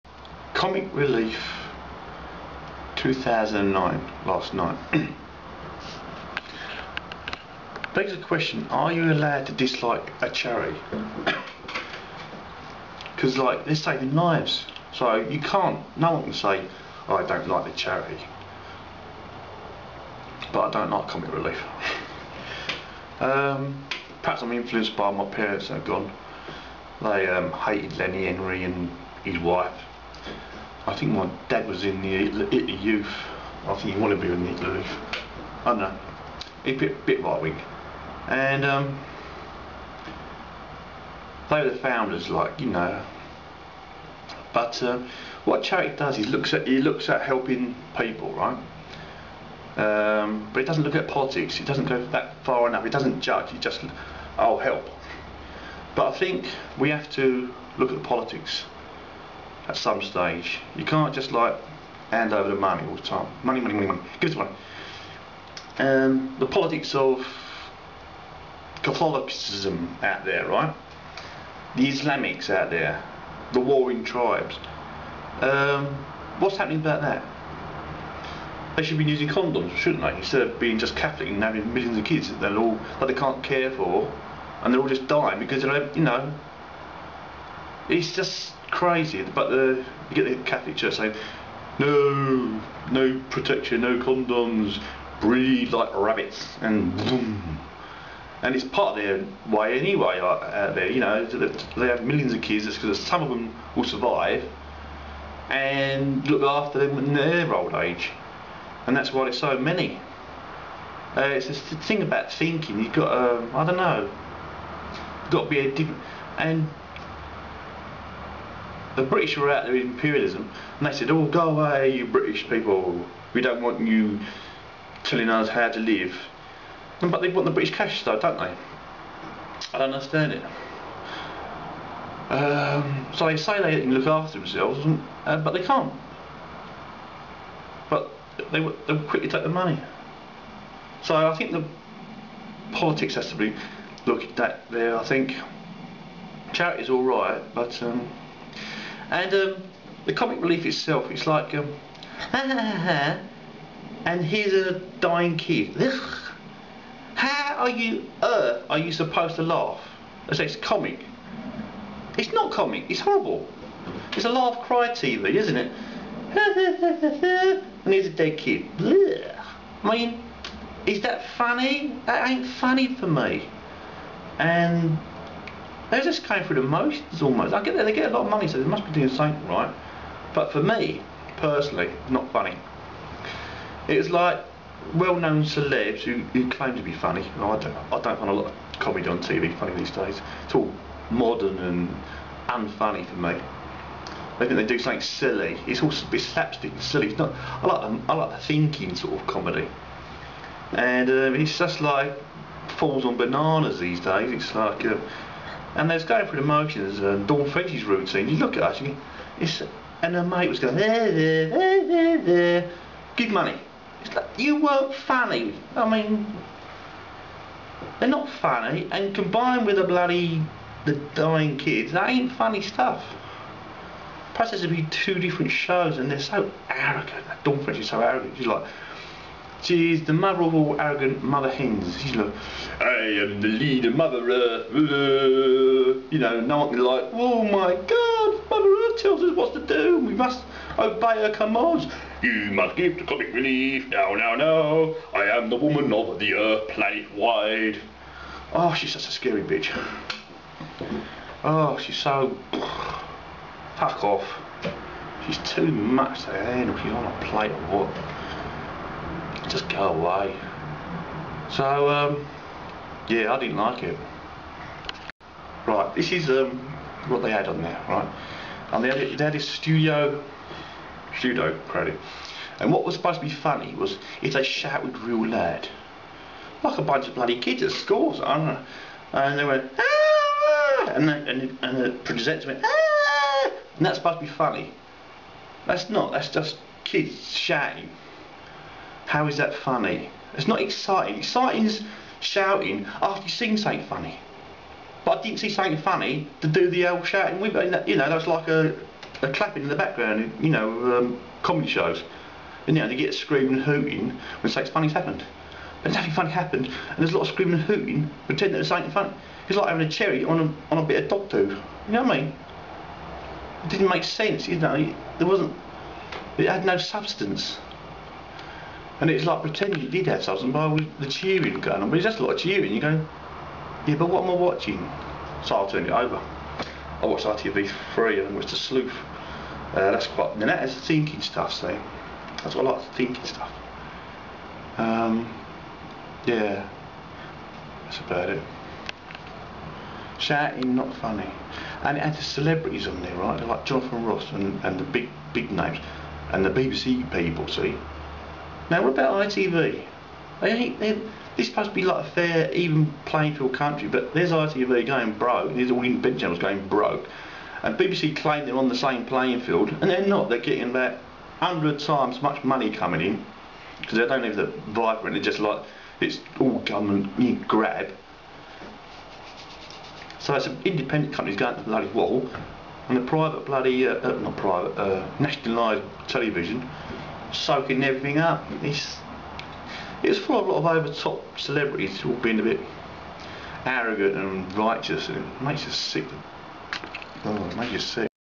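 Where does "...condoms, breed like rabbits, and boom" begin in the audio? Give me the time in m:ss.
1:33.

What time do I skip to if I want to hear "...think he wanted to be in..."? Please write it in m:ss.
0:33.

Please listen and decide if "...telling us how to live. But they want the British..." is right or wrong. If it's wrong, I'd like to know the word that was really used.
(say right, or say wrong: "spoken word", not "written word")
right.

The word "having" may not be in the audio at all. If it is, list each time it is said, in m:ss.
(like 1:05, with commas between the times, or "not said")
1:21, 5:09.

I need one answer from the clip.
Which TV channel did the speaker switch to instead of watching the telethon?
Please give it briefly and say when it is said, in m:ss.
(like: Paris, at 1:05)
ITV3, at 5:27.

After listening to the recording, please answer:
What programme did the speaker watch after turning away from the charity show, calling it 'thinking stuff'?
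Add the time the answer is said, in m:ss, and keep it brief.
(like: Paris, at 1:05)
The Sleuth, at 5:28.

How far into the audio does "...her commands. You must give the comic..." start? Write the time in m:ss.
4:01.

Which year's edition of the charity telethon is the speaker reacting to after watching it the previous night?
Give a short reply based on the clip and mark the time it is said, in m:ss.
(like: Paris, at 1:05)
2009, at 0:02.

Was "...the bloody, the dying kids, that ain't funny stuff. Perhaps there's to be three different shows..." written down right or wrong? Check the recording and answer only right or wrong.
wrong.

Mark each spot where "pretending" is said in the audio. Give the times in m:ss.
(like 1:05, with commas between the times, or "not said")
5:08, 5:19.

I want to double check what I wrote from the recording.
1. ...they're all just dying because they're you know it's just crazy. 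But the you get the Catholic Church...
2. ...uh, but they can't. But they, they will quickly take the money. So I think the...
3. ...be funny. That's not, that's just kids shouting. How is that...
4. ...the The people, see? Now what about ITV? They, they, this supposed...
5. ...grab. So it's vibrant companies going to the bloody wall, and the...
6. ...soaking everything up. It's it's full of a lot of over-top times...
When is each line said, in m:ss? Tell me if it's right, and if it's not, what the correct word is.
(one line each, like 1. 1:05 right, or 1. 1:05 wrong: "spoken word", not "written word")
1. 1:24 right
2. 2:15 right
3. 4:44 right
4. 5:46 wrong: "BBC", not "The"
5. 6:07 wrong: "independent", not "vibrant"
6. 6:17 wrong: "celebrities", not "times".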